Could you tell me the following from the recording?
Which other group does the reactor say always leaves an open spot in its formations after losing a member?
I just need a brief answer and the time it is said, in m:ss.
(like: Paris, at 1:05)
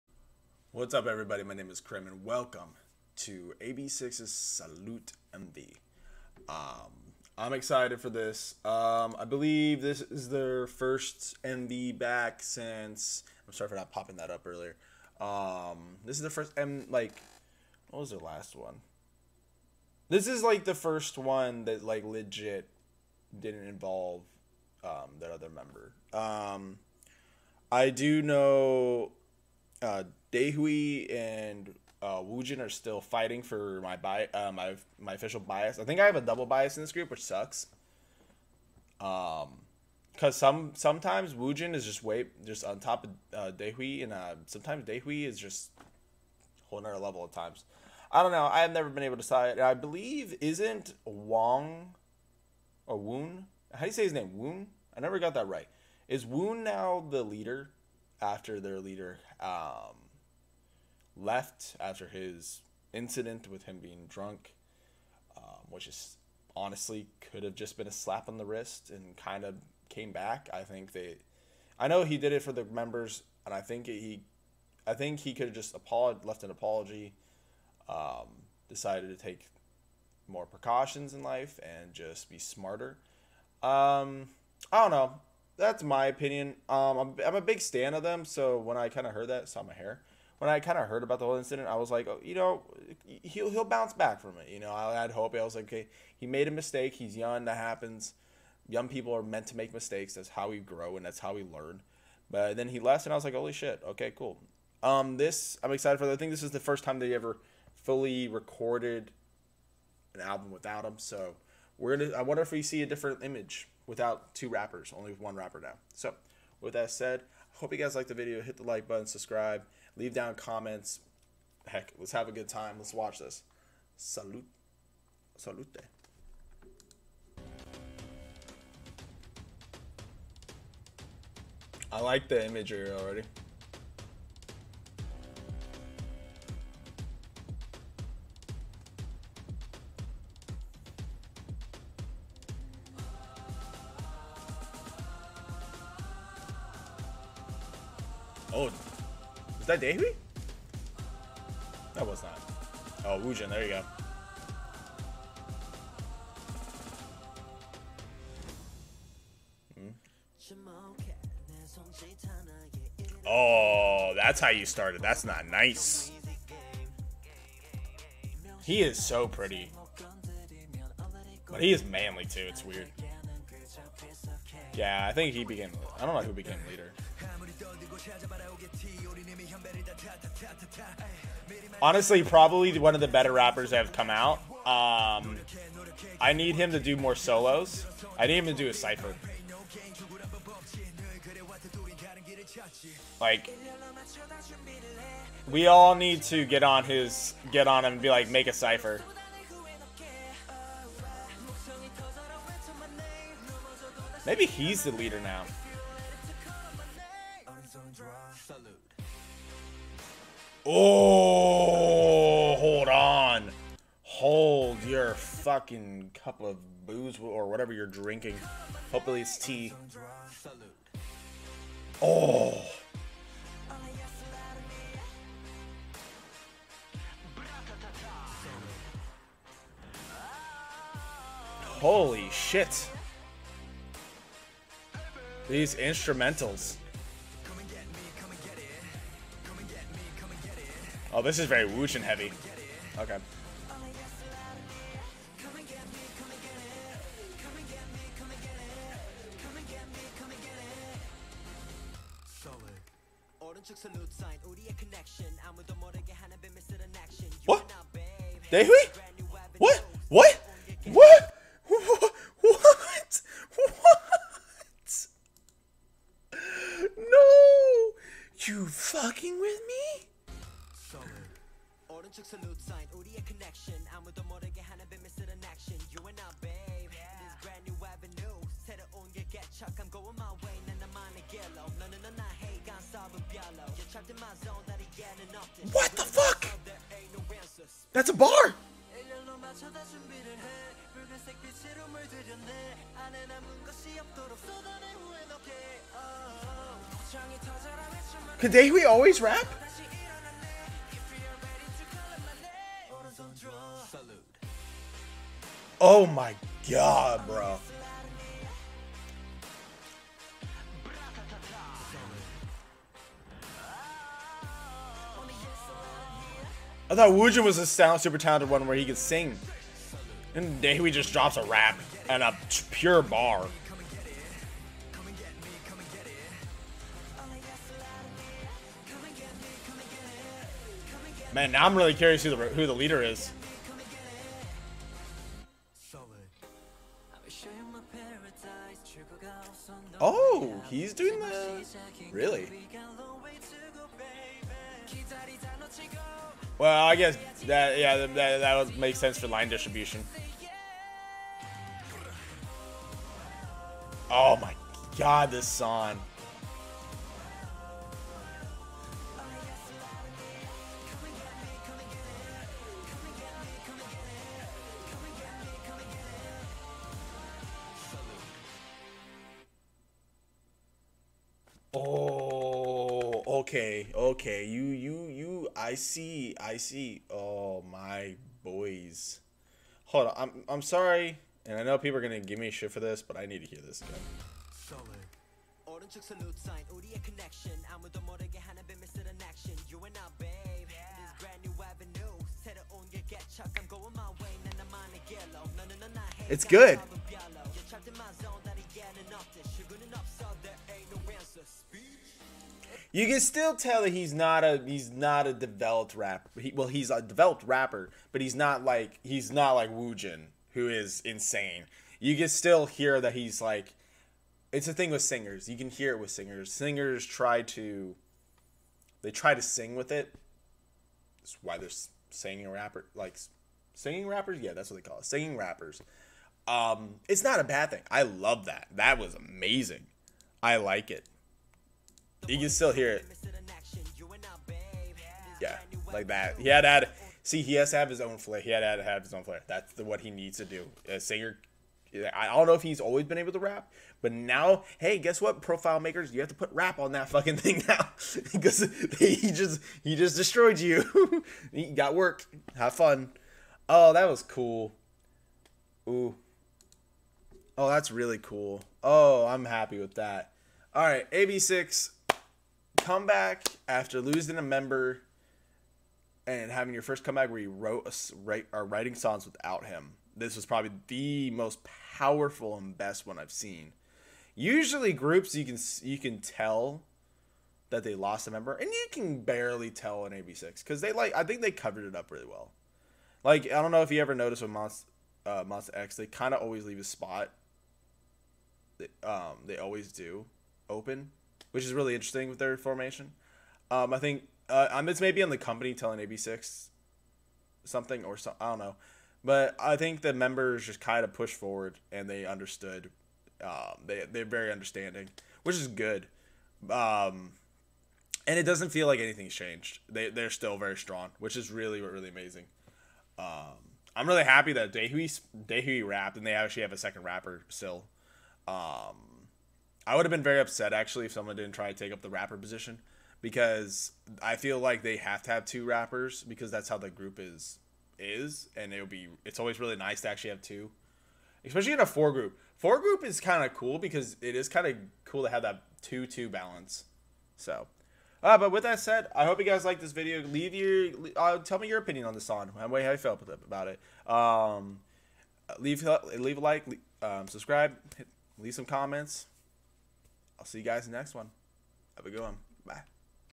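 Monsta X, at 8:05.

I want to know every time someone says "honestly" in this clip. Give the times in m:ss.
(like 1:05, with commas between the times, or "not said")
1:06, 3:01.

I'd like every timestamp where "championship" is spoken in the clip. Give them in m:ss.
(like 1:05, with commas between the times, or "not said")
not said.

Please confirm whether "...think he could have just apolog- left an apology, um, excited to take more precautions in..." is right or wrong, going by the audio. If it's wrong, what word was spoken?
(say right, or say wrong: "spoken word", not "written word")
wrong: "decided", not "excited".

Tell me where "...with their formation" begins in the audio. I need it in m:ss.
8:12.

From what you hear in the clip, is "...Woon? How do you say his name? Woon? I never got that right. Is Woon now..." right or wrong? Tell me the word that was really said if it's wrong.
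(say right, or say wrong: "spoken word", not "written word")
right.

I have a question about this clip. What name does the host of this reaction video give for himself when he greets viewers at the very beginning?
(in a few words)
Crim.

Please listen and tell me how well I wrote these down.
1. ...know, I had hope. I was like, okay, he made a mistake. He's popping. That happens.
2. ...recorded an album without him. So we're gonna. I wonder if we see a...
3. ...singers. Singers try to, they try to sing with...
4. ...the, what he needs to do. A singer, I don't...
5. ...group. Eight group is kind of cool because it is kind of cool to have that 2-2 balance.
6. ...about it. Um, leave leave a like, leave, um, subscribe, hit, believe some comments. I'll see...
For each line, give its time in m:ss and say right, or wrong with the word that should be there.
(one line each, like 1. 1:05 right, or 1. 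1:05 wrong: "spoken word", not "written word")
1. 1:34 wrong: "young", not "popping"
2. 1:48 right
3. 6:56 right
4. 7:19 right
5. 8:52 wrong: "Four", not "Eight"
6. 9:03 wrong: "leave", not "believe".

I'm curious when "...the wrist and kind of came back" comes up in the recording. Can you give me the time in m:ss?
1:08.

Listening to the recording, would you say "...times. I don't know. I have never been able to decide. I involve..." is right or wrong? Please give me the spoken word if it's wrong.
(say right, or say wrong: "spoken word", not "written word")
wrong: "believe", not "involve".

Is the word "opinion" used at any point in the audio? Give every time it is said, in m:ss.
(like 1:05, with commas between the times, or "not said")
1:26, 9:01.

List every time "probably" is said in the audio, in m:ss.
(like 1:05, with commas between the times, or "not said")
3:02, 7:50.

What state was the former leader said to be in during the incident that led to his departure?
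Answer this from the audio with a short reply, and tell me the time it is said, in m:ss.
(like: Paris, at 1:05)
Drunk, at 1:04.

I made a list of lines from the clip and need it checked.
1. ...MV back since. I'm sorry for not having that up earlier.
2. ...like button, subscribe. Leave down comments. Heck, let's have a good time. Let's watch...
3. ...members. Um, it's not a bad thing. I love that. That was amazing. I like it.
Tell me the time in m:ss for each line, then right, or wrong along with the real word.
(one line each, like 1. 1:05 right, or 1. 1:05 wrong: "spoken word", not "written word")
1. 0:11 wrong: "popping", not "having"
2. 1:58 right
3. 7:05 wrong: "rappers", not "members".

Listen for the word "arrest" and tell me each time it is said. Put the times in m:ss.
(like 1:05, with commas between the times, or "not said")
not said.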